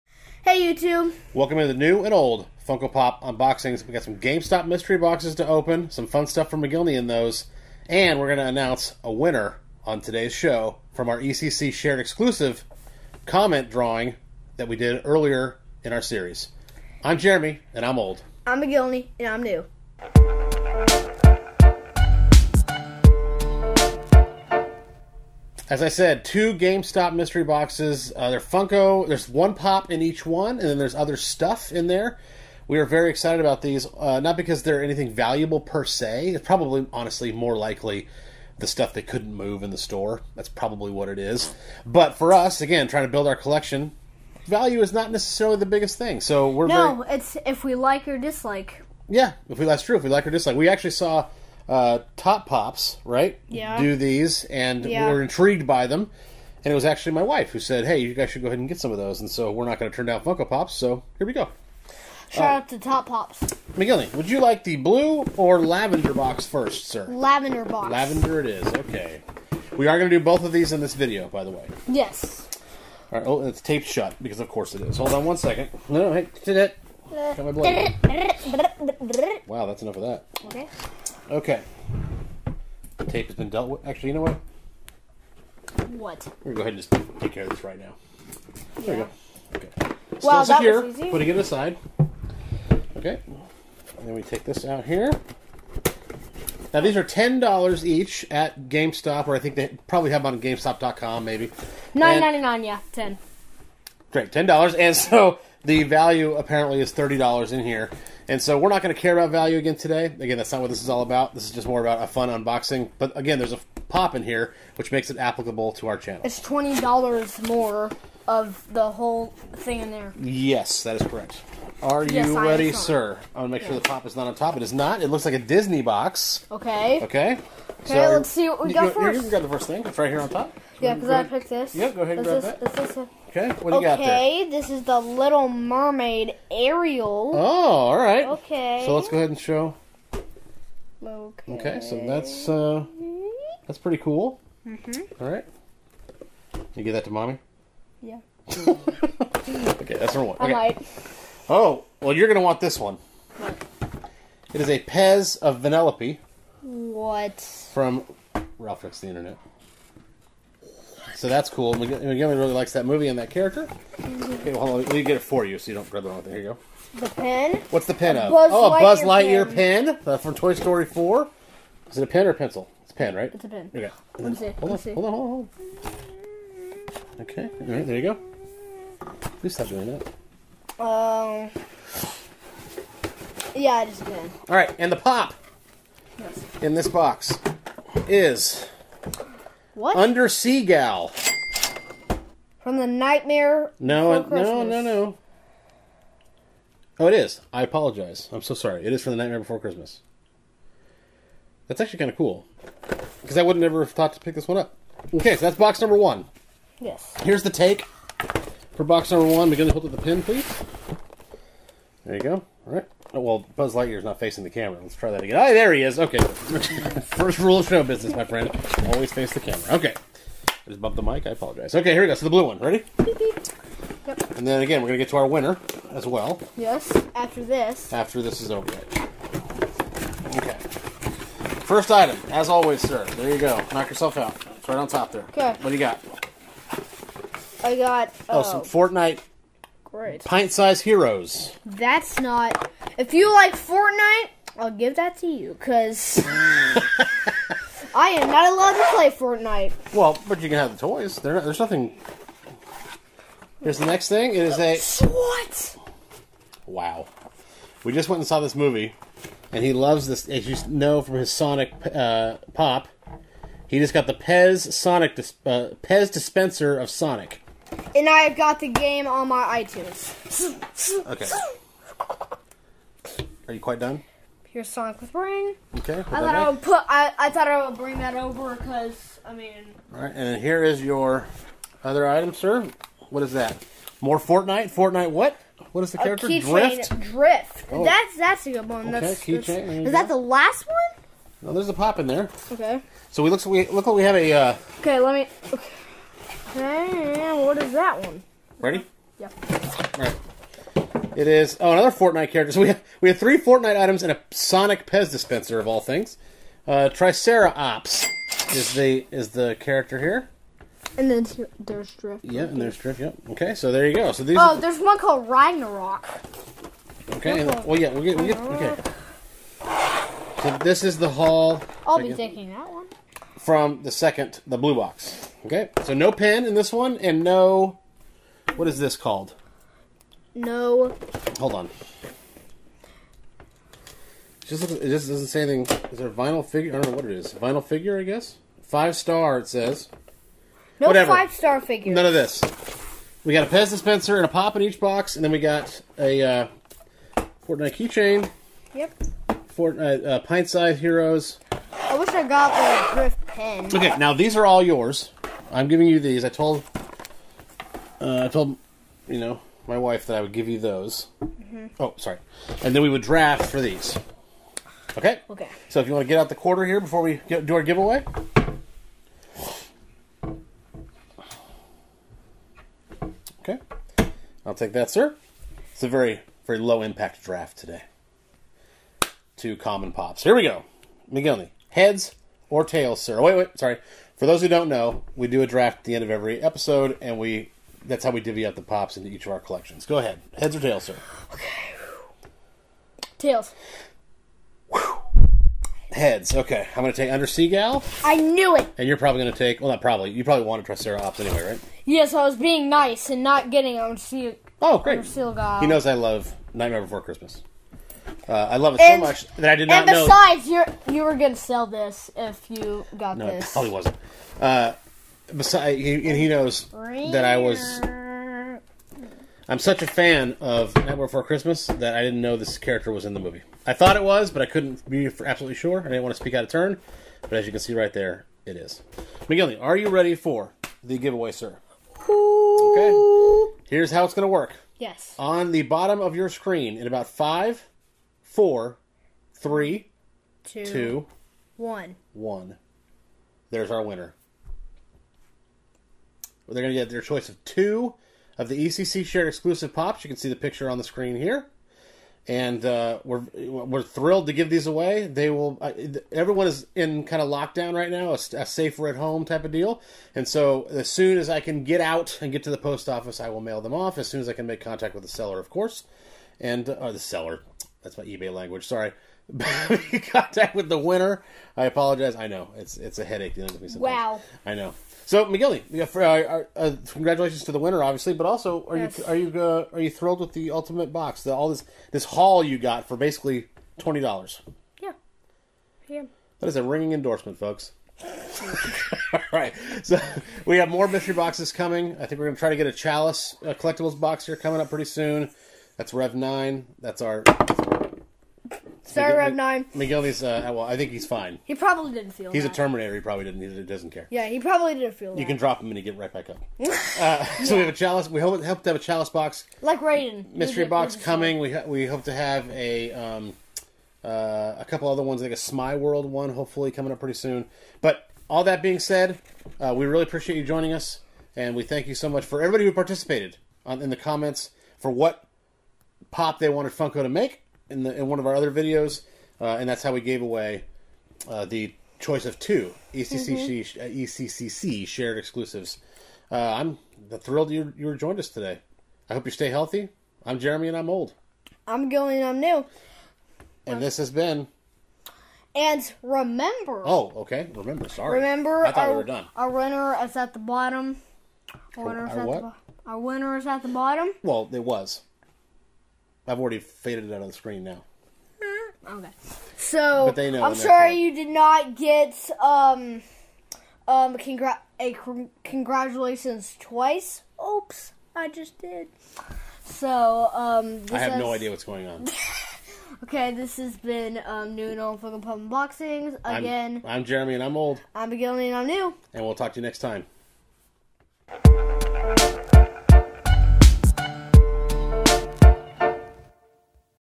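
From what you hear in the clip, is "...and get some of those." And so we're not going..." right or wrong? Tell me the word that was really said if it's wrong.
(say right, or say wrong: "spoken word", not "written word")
right.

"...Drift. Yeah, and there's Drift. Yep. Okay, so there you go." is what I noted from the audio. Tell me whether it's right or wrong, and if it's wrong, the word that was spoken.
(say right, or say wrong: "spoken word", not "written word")
right.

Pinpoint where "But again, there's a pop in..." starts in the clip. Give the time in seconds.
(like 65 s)
112 s.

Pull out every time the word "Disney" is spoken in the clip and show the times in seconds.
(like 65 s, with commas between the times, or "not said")
125 s.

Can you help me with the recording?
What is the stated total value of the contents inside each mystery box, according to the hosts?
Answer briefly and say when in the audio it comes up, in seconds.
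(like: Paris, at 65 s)
$30, at 106 s.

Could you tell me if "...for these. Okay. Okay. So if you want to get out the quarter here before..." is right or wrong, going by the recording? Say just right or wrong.
right.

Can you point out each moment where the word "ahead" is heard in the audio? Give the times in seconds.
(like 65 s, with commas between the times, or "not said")
58 s, 86 s, 132 s, 139 s, 389 s.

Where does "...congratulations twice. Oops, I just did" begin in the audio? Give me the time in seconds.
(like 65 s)
565 s.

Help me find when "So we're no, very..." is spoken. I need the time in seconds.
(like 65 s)
46 s.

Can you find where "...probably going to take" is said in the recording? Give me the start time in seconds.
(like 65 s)
398 s.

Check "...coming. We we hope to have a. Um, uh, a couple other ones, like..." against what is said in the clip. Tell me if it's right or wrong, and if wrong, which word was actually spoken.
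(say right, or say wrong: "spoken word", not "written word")
right.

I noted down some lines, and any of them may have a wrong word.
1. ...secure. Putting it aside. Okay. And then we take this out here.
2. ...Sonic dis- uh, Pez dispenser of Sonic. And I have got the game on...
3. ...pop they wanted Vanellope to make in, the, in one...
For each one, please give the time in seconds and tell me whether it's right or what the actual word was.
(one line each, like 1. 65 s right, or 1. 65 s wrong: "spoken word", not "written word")
1. 90 s right
2. 264 s right
3. 526 s wrong: "Funko", not "Vanellope".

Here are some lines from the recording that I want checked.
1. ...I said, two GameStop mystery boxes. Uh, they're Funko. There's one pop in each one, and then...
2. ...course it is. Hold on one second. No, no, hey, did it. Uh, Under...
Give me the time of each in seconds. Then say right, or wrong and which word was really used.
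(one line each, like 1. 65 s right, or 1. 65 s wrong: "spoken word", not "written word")
1. 25 s right
2. 74 s wrong: "Got", not "Under".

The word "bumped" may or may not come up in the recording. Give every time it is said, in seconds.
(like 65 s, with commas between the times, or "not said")
220 s.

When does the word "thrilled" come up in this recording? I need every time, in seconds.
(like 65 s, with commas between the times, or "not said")
453 s, 479 s, 537 s.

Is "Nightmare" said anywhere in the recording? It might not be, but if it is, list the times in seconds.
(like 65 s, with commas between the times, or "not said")
192 s, 199 s, 406 s, 420 s.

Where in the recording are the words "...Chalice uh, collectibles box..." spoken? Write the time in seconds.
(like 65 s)
492 s.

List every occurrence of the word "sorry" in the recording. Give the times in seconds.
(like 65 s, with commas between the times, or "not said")
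198 s, 361 s, 383 s, 468 s, 498 s, 547 s, 560 s.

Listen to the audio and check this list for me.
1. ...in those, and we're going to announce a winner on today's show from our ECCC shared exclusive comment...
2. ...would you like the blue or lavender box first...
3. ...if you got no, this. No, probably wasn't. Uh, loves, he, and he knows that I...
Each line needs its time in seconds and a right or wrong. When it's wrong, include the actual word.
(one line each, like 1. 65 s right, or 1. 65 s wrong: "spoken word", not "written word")
1. 6 s right
2. 64 s right
3. 412 s wrong: "besides", not "loves".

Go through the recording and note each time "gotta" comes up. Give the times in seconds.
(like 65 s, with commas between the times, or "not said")
not said.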